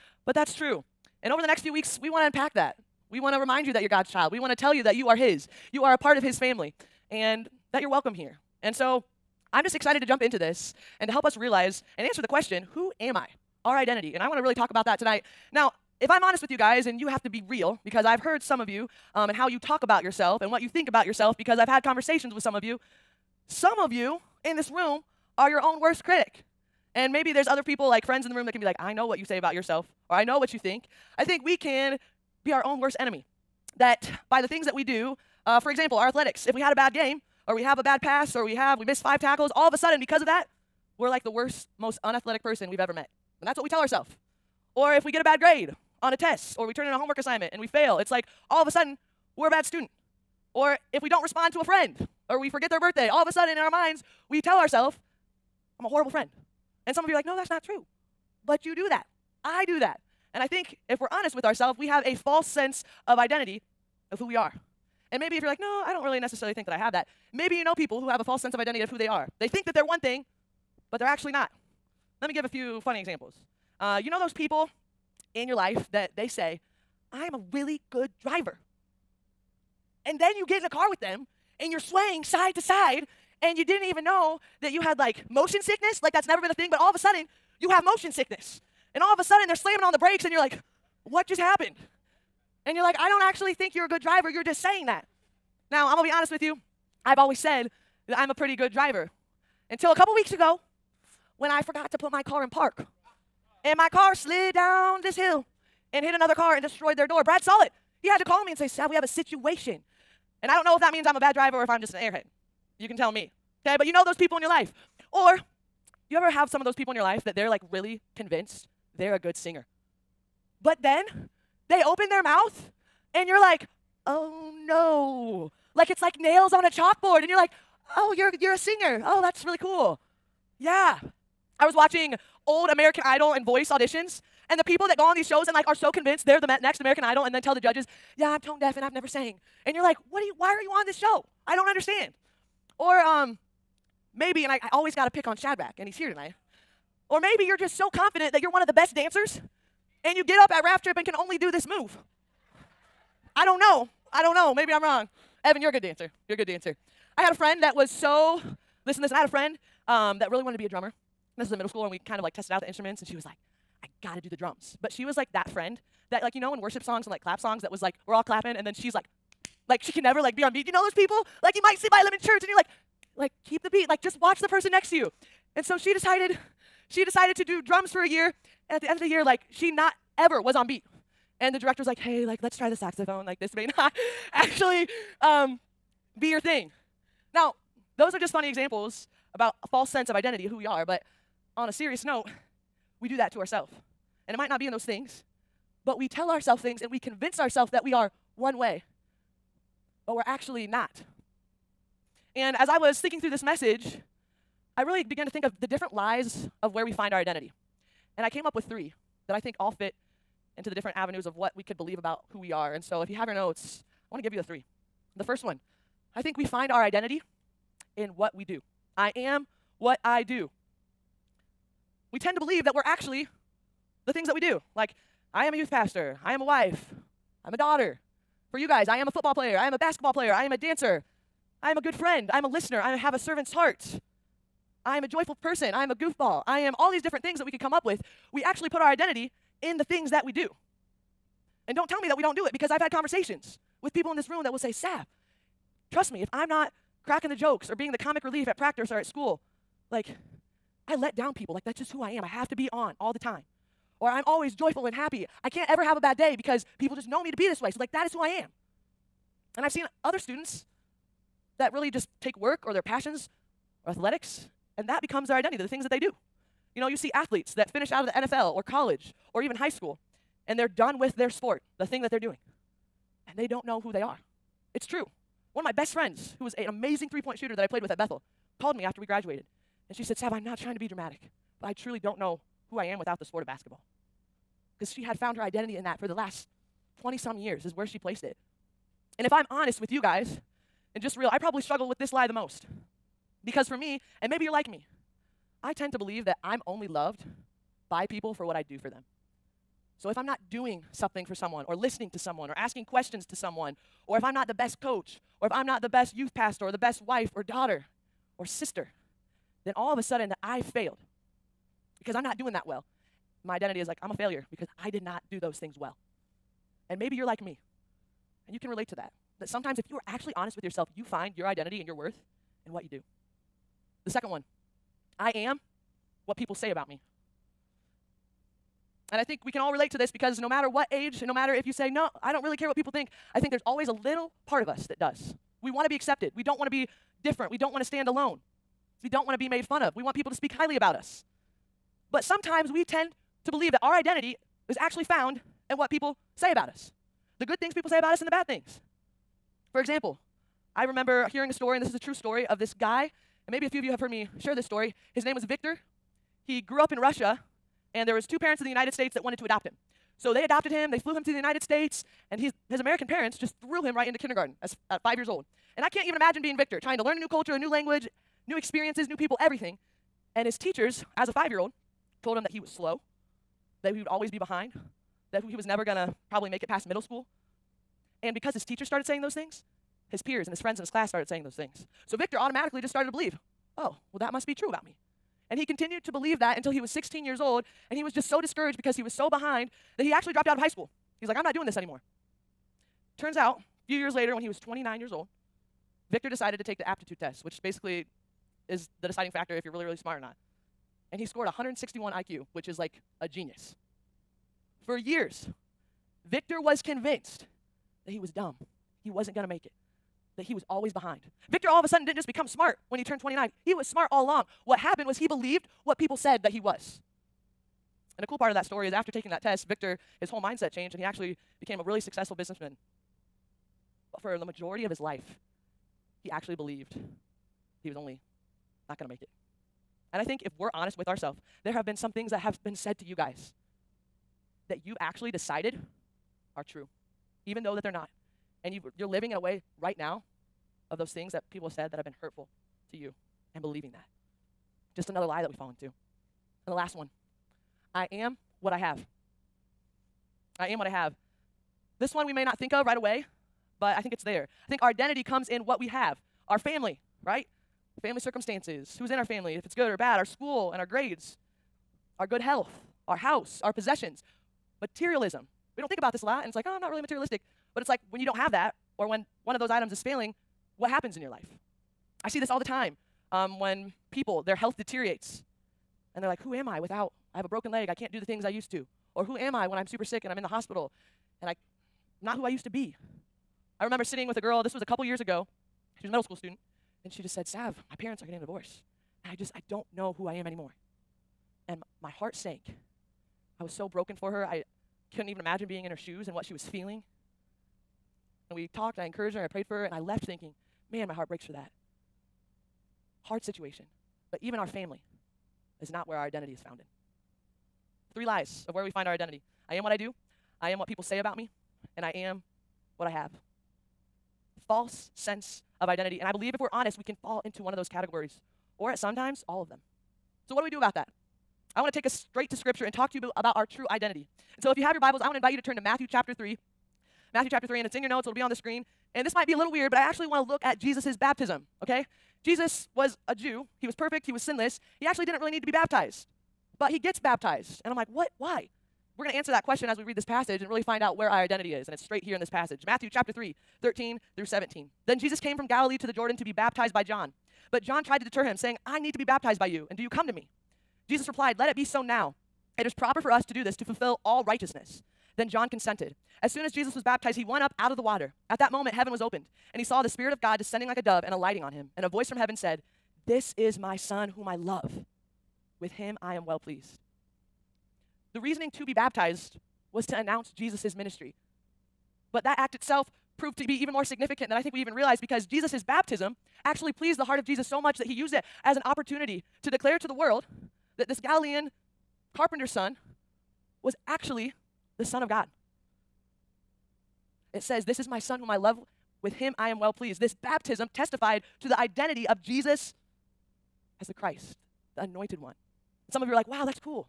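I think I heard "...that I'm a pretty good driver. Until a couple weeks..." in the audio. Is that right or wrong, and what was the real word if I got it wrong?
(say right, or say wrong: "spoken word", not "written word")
right.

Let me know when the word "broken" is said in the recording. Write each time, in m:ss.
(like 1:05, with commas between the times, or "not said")
7:57, 8:13.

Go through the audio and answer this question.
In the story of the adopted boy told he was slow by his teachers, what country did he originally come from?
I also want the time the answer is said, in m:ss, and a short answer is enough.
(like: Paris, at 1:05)
Russia, at 5:56.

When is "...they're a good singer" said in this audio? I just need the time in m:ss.
1:58.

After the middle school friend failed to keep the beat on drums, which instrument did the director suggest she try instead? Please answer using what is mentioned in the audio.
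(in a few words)
saxophone.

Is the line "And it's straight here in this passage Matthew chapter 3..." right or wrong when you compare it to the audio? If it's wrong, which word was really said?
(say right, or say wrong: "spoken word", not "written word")
right.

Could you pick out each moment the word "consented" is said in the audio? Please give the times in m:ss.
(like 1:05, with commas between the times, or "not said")
9:15.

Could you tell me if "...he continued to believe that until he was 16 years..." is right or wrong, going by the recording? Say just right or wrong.
right.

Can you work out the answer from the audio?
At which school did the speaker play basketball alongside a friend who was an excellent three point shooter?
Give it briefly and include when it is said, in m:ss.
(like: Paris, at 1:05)
Bethel, at 4:37.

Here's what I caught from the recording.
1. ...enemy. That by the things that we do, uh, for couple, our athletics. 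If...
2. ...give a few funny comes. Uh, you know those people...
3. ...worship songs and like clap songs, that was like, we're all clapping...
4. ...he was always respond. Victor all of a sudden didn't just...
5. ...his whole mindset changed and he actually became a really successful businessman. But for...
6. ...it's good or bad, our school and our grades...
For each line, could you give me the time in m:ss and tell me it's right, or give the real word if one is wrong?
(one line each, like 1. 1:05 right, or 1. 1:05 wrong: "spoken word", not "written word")
1. 0:32 wrong: "example", not "couple"
2. 1:12 wrong: "examples", not "comes"
3. 2:46 right
4. 6:50 wrong: "behind", not "respond"
5. 7:00 right
6. 7:39 right.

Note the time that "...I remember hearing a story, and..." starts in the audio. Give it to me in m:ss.
5:50.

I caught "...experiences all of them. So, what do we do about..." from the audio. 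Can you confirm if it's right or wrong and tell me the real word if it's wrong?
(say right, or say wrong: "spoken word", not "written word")
wrong: "sometimes", not "experiences".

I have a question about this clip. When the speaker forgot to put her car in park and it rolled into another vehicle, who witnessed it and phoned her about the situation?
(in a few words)
Brad.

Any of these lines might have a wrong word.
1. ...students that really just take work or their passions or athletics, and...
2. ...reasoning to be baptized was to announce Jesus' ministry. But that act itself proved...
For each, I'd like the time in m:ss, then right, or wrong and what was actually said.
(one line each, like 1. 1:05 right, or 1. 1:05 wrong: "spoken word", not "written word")
1. 4:20 right
2. 9:28 right.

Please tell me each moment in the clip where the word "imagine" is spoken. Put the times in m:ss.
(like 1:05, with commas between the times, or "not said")
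6:06, 8:15.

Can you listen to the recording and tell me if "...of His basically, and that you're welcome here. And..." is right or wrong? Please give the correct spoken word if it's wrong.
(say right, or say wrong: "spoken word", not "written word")
wrong: "family", not "basically".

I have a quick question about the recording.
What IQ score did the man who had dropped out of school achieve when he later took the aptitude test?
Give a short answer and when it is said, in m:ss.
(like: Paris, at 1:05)
161, at 6:41.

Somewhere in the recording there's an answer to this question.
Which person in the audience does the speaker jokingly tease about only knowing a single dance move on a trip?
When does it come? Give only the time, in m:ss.
2:25.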